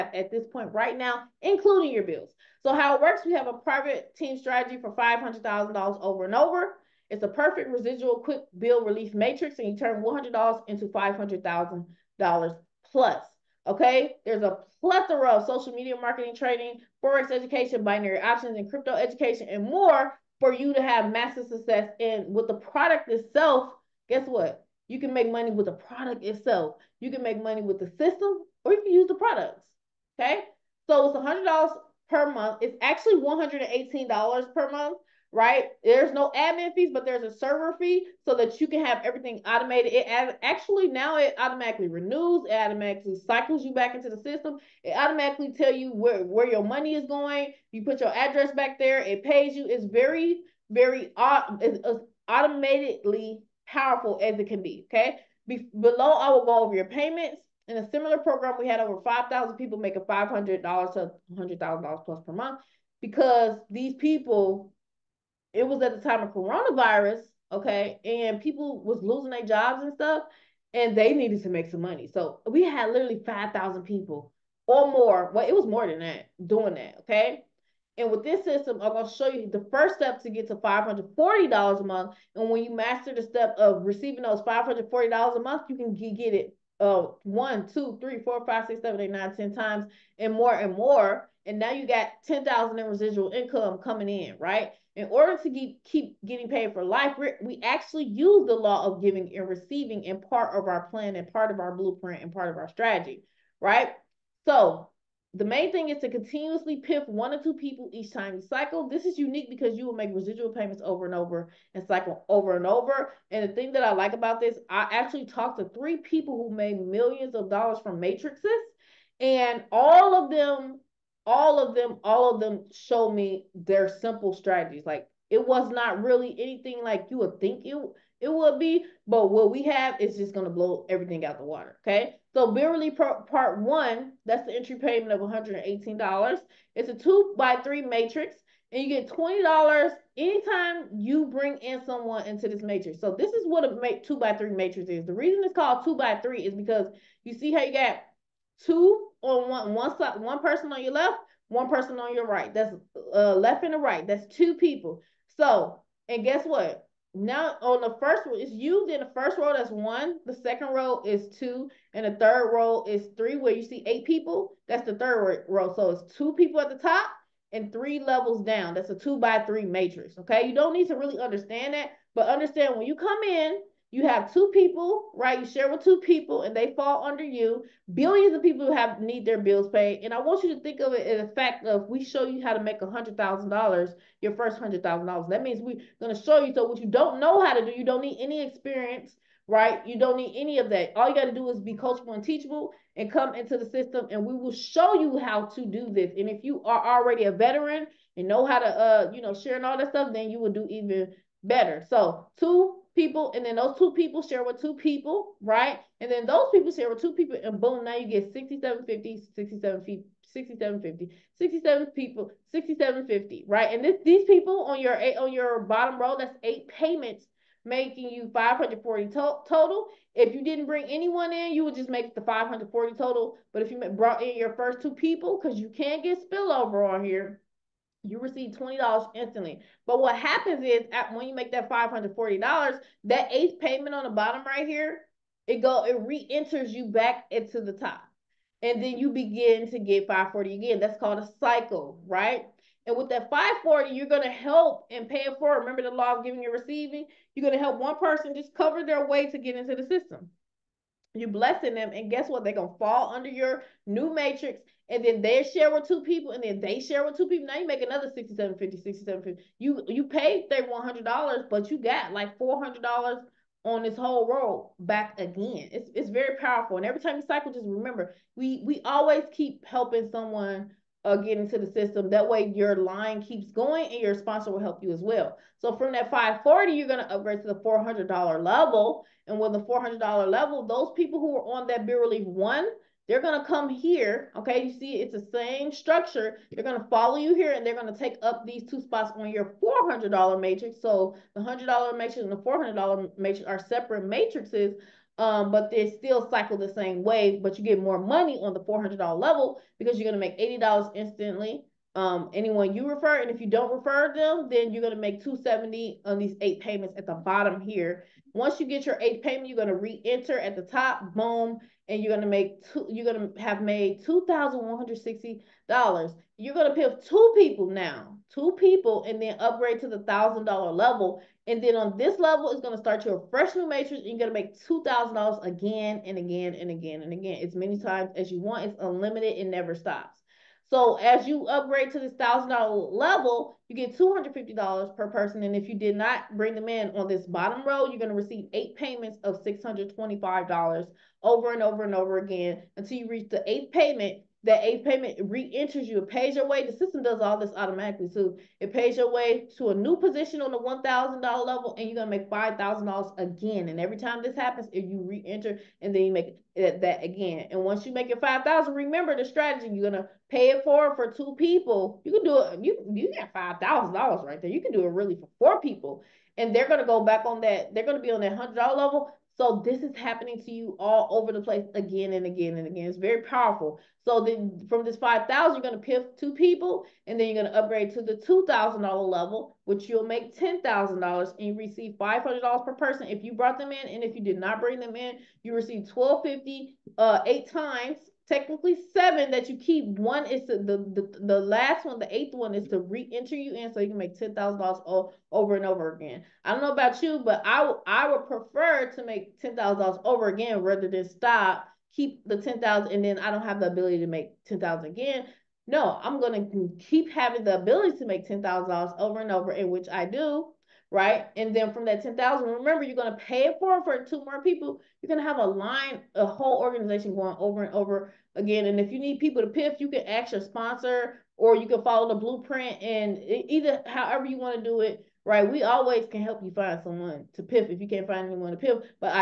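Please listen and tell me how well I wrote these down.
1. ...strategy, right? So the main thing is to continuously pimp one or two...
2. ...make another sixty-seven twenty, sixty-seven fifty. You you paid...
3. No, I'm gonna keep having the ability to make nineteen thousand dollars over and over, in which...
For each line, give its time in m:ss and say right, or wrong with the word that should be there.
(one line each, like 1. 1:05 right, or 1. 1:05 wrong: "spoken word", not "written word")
1. 1:42 right
2. 4:17 wrong: "fifty", not "twenty"
3. 6:45 wrong: "ten", not "nineteen".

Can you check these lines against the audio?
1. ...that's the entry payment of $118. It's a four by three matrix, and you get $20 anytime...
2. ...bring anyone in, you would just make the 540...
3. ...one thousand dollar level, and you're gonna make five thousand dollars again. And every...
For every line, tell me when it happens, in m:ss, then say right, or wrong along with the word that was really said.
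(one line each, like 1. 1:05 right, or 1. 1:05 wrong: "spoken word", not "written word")
1. 2:14 wrong: "two", not "four"
2. 3:40 right
3. 5:50 right.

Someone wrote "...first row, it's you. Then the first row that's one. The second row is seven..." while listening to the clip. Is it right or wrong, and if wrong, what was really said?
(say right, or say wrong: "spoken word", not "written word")
wrong: "two", not "seven".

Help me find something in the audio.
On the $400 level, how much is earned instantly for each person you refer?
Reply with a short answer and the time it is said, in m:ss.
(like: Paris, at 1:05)
$80, at 5:00.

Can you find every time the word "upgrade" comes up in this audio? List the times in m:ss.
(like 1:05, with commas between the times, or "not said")
4:37, 5:19, 5:31, 6:17.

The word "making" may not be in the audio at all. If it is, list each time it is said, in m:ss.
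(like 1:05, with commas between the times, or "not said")
0:59, 3:37.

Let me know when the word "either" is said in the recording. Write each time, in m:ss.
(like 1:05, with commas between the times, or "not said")
7:03.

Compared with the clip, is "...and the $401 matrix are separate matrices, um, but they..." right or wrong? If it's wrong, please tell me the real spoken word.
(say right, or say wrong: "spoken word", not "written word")
wrong: "400", not "401".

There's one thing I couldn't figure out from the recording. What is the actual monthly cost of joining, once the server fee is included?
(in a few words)
$118.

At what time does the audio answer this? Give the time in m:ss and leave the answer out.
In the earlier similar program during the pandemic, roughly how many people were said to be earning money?
0:59.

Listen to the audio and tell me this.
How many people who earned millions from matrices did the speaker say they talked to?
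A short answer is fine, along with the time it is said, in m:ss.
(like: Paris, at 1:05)
3, at 1:55.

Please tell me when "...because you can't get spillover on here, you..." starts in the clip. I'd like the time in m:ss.
3:45.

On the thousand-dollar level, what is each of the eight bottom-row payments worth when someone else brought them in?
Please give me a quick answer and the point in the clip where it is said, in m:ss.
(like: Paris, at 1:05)
$625, at 5:39.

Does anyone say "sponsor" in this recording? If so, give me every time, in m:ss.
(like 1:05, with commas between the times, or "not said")
4:34, 7:00.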